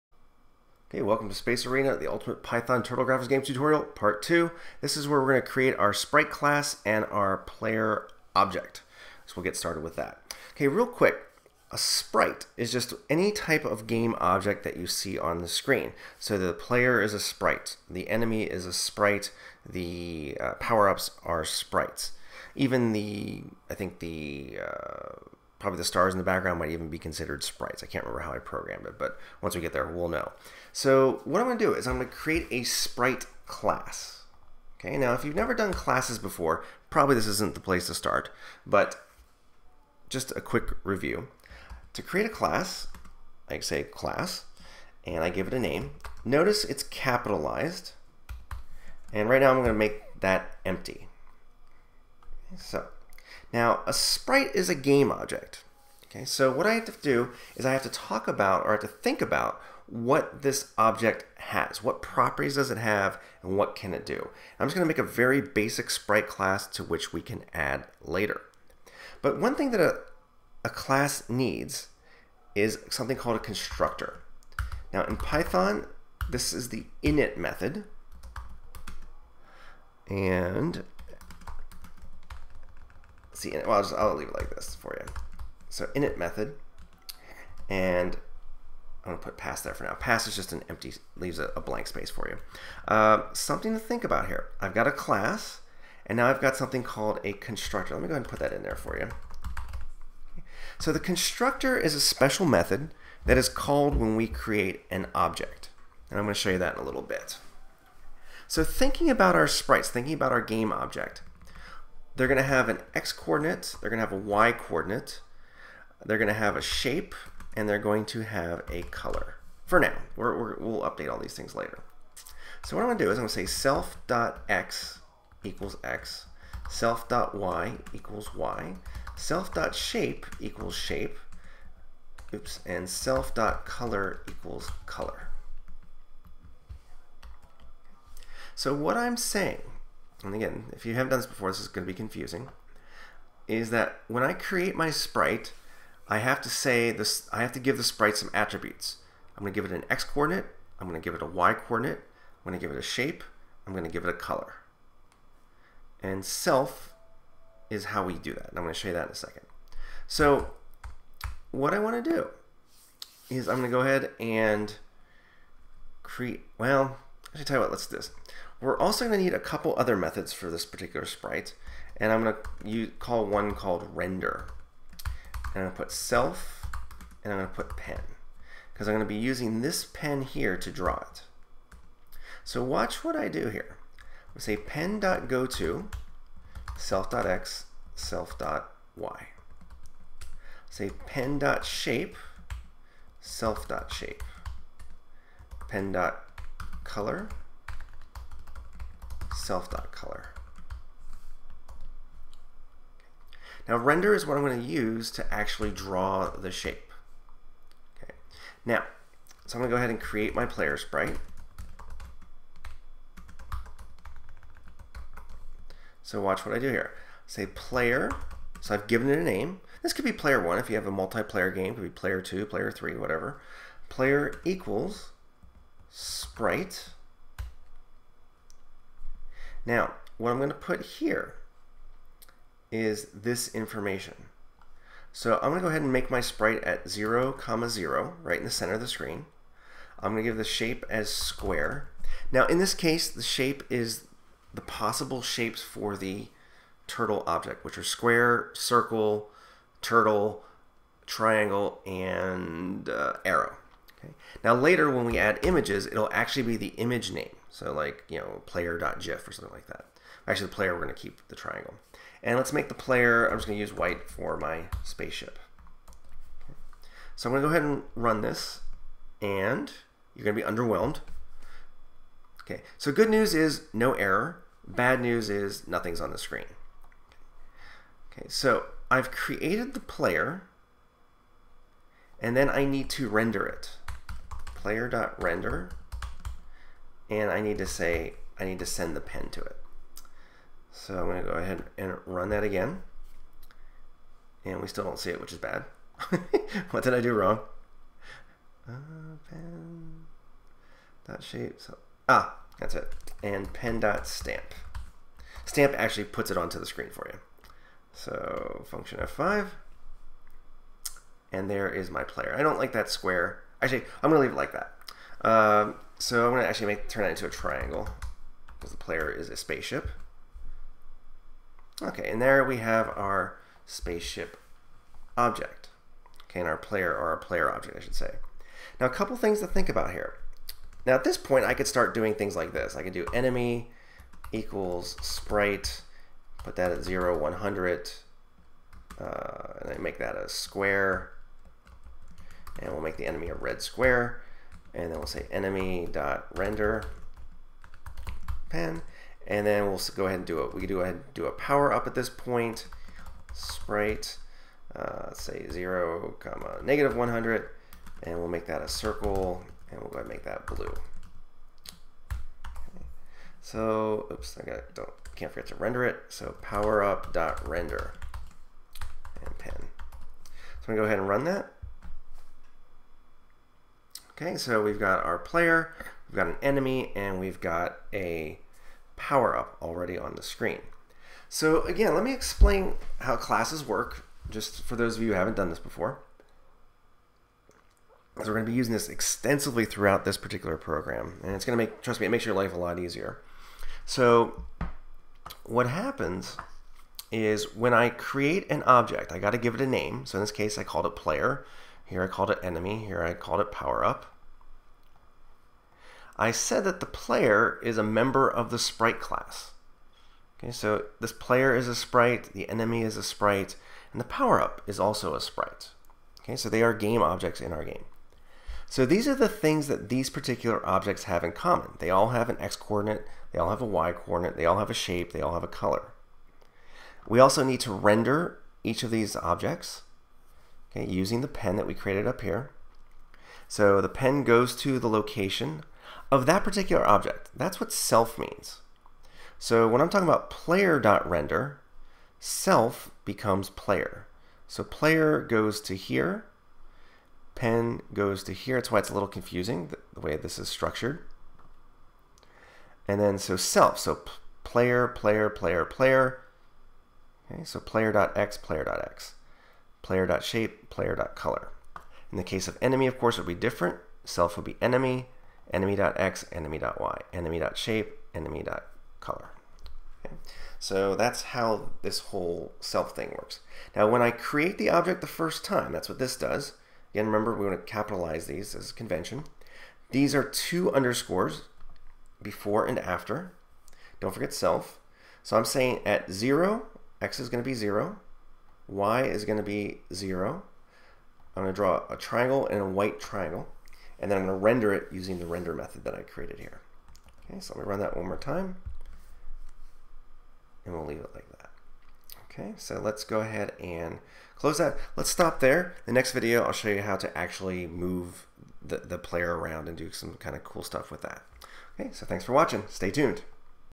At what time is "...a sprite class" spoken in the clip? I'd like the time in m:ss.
0:32.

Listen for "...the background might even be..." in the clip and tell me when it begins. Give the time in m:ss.
0:26.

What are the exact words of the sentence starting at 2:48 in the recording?
We're also going to need a couple other methods for this particular sprite, and I'm going to call one called render.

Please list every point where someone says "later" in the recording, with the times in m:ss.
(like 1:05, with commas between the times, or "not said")
1:08, 2:01, 4:14.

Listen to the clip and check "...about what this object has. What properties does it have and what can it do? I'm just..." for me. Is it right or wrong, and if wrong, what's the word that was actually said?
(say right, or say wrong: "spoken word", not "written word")
right.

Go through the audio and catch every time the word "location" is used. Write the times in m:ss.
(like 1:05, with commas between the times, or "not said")
7:14.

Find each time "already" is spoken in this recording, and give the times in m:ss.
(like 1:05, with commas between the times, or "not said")
6:19.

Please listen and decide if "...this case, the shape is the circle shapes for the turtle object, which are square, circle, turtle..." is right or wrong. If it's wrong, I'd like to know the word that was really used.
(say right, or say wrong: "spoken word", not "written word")
wrong: "possible", not "circle".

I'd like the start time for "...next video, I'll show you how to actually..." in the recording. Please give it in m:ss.
8:25.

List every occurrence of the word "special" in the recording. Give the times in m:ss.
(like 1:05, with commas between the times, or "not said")
1:41.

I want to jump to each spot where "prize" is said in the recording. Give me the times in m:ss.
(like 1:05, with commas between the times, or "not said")
not said.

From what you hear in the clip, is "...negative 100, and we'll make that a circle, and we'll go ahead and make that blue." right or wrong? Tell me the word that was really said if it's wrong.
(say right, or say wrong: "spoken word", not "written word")
right.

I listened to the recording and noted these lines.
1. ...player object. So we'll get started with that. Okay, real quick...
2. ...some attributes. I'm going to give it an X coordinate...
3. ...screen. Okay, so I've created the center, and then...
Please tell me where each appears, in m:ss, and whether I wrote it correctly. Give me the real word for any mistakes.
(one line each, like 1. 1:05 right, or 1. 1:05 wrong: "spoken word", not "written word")
1. 0:07 right
2. 2:28 right
3. 4:36 wrong: "player", not "center".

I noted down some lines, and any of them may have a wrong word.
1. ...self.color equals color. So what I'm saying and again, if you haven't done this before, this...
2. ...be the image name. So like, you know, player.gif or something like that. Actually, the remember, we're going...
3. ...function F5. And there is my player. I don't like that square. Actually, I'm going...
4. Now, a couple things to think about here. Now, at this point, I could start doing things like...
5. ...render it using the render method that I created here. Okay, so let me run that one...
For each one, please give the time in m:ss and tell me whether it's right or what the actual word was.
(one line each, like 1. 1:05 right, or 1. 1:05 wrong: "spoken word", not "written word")
1. 2:12 right
2. 4:16 wrong: "player", not "remember"
3. 5:08 right
4. 5:28 right
5. 8:14 right.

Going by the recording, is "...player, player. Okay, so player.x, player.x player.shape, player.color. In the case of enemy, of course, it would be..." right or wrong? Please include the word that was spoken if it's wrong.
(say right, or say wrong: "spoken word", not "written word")
right.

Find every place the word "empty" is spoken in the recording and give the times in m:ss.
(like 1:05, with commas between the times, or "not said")
0:50, 1:30.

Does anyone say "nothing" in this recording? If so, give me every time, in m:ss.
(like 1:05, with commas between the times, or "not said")
4:35.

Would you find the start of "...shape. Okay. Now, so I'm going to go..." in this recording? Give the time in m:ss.
3:26.